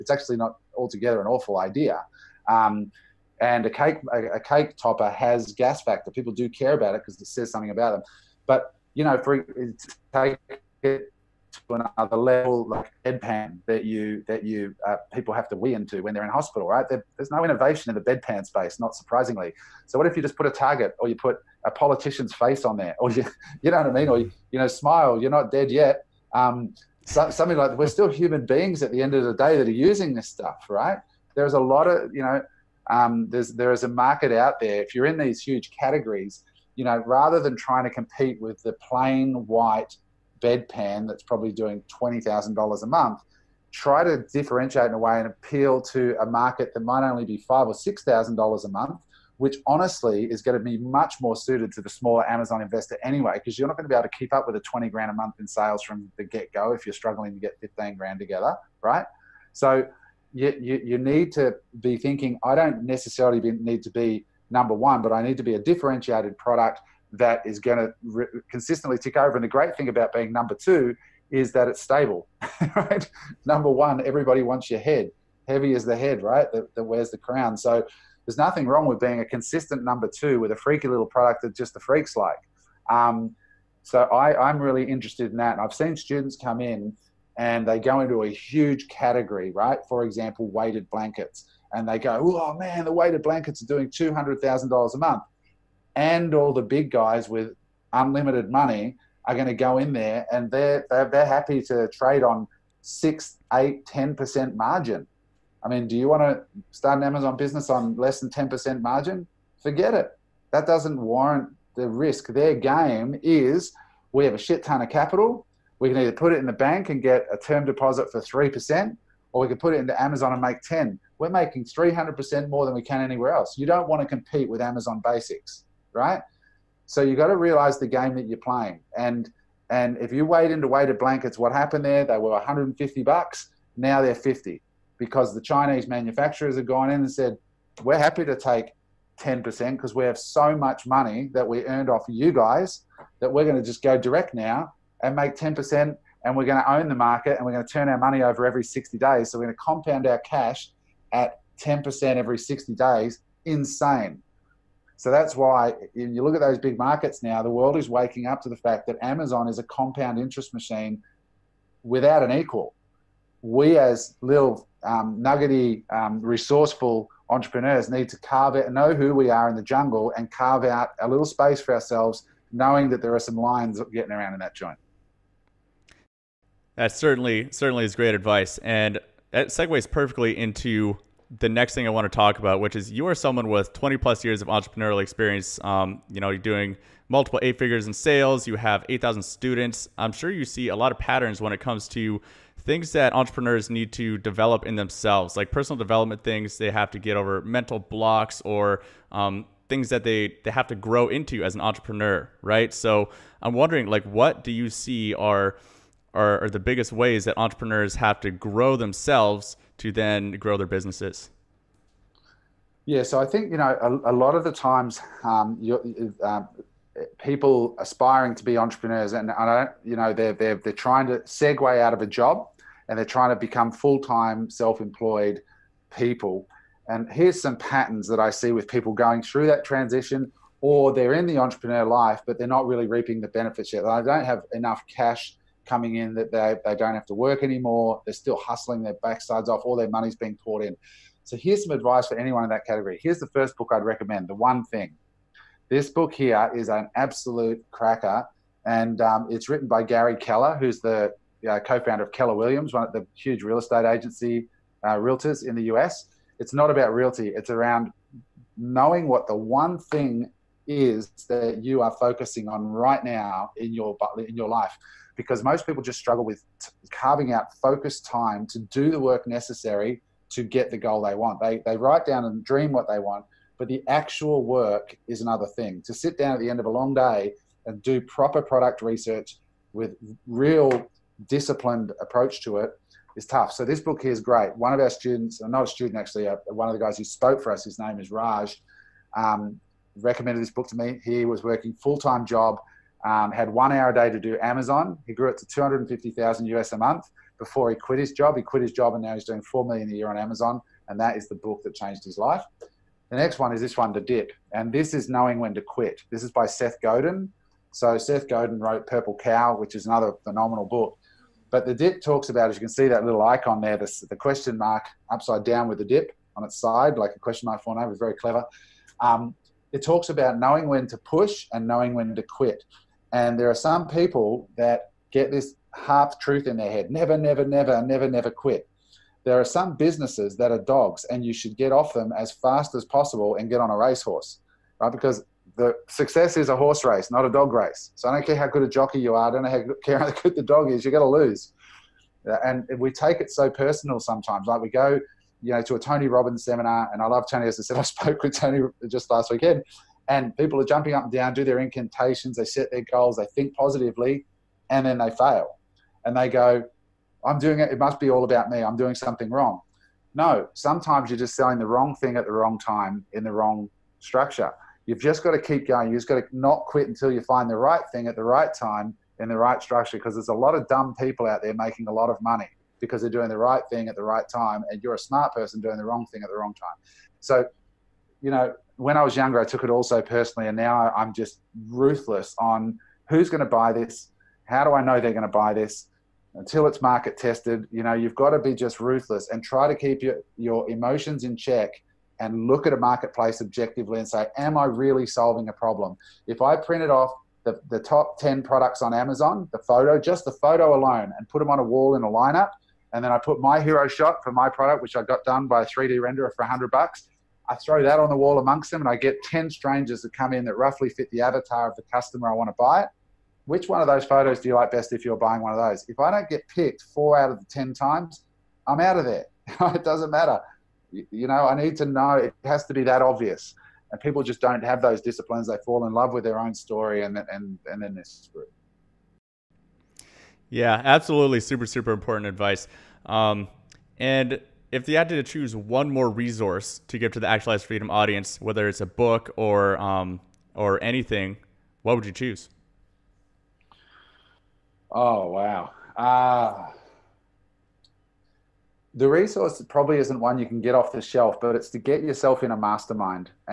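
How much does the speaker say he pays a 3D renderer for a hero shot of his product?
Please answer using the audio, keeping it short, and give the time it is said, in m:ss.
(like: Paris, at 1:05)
$100, at 6:46.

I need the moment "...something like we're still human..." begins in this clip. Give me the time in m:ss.
0:27.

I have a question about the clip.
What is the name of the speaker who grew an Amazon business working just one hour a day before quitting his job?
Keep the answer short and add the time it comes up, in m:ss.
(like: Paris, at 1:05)
Raj, at 4:48.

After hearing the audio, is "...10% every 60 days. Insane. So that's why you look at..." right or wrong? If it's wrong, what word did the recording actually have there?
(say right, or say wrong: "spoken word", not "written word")
right.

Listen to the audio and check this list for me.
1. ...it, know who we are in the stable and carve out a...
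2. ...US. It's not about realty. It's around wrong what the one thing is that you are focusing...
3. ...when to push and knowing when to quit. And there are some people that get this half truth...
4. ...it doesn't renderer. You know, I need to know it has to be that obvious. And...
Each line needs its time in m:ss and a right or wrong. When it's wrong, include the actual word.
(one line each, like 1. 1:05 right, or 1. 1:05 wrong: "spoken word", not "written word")
1. 2:48 wrong: "jungle", not "stable"
2. 4:15 wrong: "knowing", not "wrong"
3. 5:20 right
4. 6:59 wrong: "matter", not "renderer".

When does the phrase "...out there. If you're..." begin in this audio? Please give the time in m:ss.
0:34.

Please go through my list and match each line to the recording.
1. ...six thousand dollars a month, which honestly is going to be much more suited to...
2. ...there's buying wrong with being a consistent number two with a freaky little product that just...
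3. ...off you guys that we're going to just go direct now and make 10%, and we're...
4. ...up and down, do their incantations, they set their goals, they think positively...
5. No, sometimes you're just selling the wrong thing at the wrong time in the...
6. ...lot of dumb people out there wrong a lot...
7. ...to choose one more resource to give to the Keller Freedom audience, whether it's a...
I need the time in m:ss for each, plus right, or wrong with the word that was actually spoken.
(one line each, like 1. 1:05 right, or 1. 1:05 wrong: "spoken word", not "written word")
1. 0:47 right
2. 1:18 wrong: "nothing", not "buying"
3. 2:21 right
4. 5:50 right
5. 6:00 right
6. 6:10 wrong: "making", not "wrong"
7. 7:15 wrong: "Actualized", not "Keller".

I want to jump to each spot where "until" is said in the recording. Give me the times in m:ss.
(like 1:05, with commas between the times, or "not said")
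6:06, 6:26.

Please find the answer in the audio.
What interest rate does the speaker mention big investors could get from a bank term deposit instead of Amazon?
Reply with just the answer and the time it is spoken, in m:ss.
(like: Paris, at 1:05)
3%, at 1:58.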